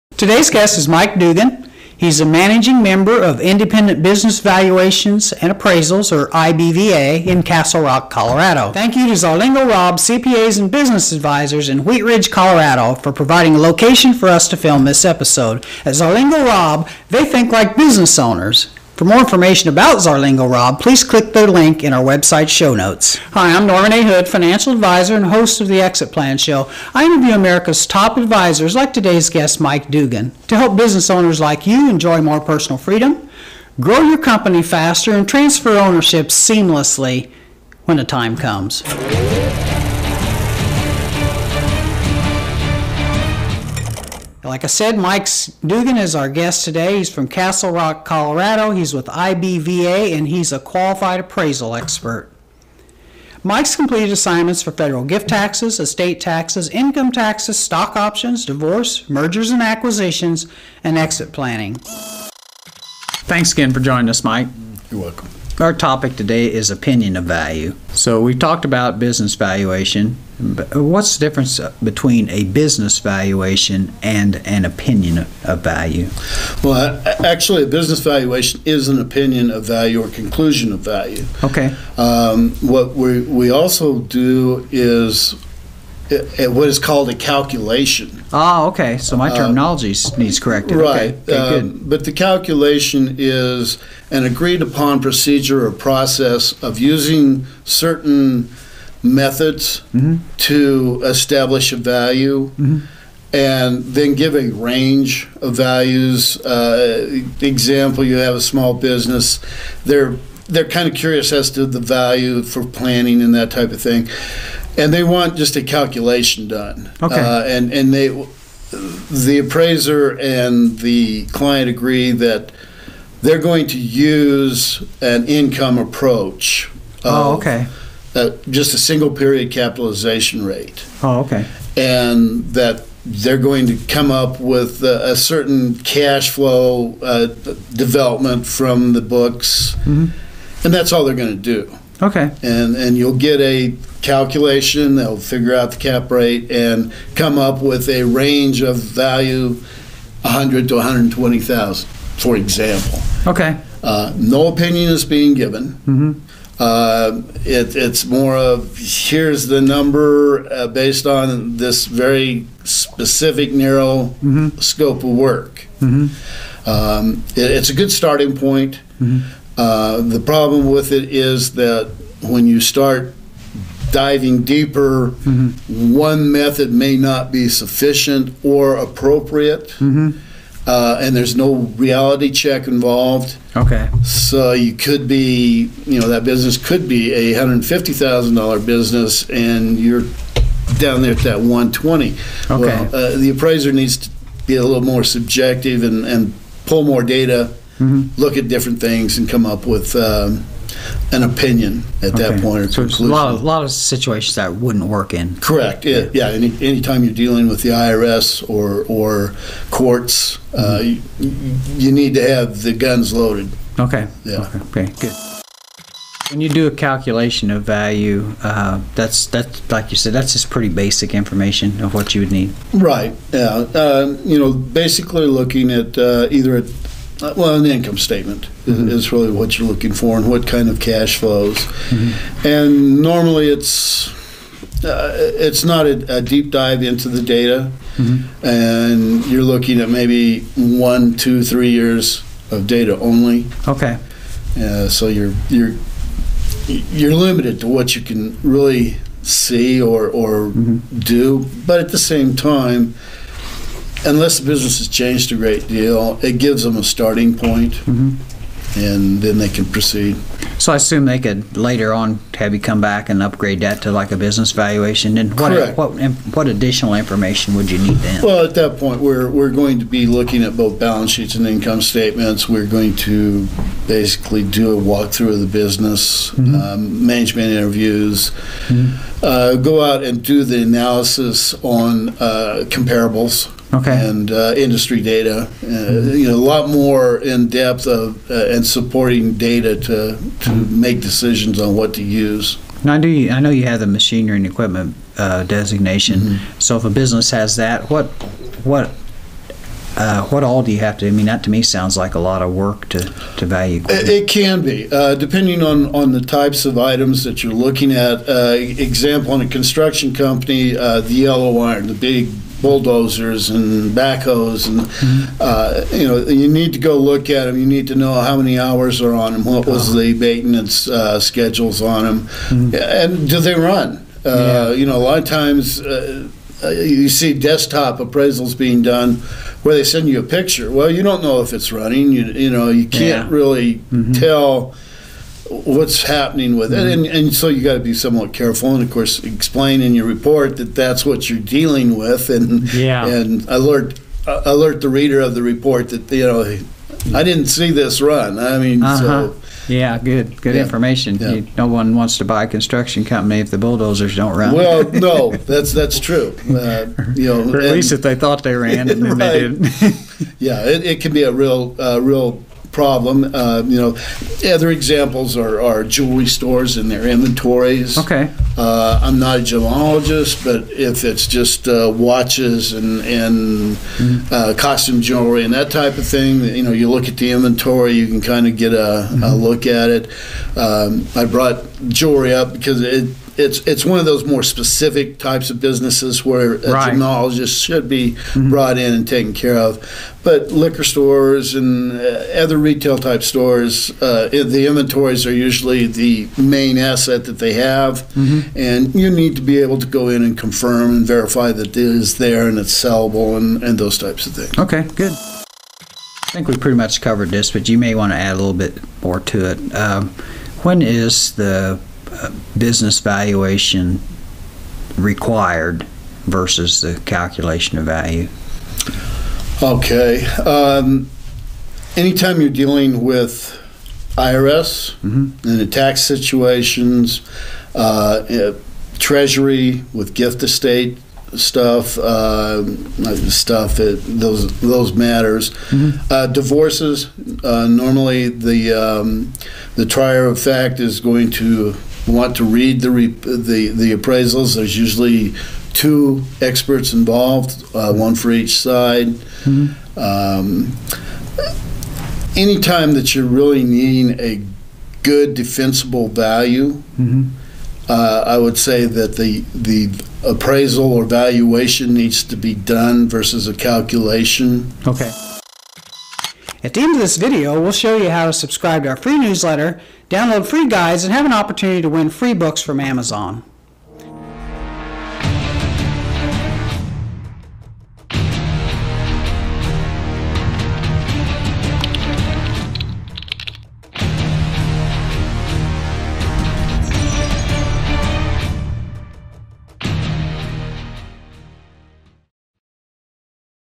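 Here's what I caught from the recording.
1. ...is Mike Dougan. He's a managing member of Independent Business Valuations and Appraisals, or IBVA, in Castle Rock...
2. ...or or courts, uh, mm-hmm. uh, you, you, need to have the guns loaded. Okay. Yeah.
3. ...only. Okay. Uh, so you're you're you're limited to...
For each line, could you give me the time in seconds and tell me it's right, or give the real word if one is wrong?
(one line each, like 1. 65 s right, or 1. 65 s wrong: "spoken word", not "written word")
1. 0 s right
2. 208 s right
3. 242 s right.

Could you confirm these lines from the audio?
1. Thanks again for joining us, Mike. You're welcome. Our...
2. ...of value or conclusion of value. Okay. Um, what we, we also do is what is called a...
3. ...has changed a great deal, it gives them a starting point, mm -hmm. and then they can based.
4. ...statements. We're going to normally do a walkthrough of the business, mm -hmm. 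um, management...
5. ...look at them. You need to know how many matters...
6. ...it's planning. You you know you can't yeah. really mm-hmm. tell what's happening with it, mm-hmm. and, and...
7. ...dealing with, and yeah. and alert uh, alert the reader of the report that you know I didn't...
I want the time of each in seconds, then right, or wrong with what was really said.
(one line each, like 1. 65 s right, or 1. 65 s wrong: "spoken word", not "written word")
1. 63 s right
2. 79 s right
3. 254 s wrong: "proceed", not "based"
4. 271 s wrong: "basically", not "normally"
5. 316 s wrong: "hours", not "matters"
6. 331 s wrong: "running", not "planning"
7. 341 s right.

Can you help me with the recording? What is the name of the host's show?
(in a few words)
Exit Plan Show.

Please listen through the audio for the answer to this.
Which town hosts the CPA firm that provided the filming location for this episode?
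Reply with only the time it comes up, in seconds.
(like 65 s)
11 s.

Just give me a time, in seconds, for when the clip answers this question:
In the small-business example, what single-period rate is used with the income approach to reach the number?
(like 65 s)
129 s.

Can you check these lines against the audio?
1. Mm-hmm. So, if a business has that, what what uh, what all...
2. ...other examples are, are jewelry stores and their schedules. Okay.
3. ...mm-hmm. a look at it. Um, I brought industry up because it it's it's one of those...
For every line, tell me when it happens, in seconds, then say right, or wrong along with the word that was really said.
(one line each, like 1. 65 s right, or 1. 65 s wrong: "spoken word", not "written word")
1. 296 s right
2. 364 s wrong: "inventories", not "schedules"
3. 379 s wrong: "jewelry", not "industry".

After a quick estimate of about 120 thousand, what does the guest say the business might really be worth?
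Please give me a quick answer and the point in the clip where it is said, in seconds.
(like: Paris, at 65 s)
$150,000, at 187 s.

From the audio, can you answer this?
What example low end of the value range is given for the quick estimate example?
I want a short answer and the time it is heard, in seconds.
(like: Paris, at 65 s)
100 thousand, at 150 s.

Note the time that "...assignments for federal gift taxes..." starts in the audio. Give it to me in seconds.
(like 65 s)
54 s.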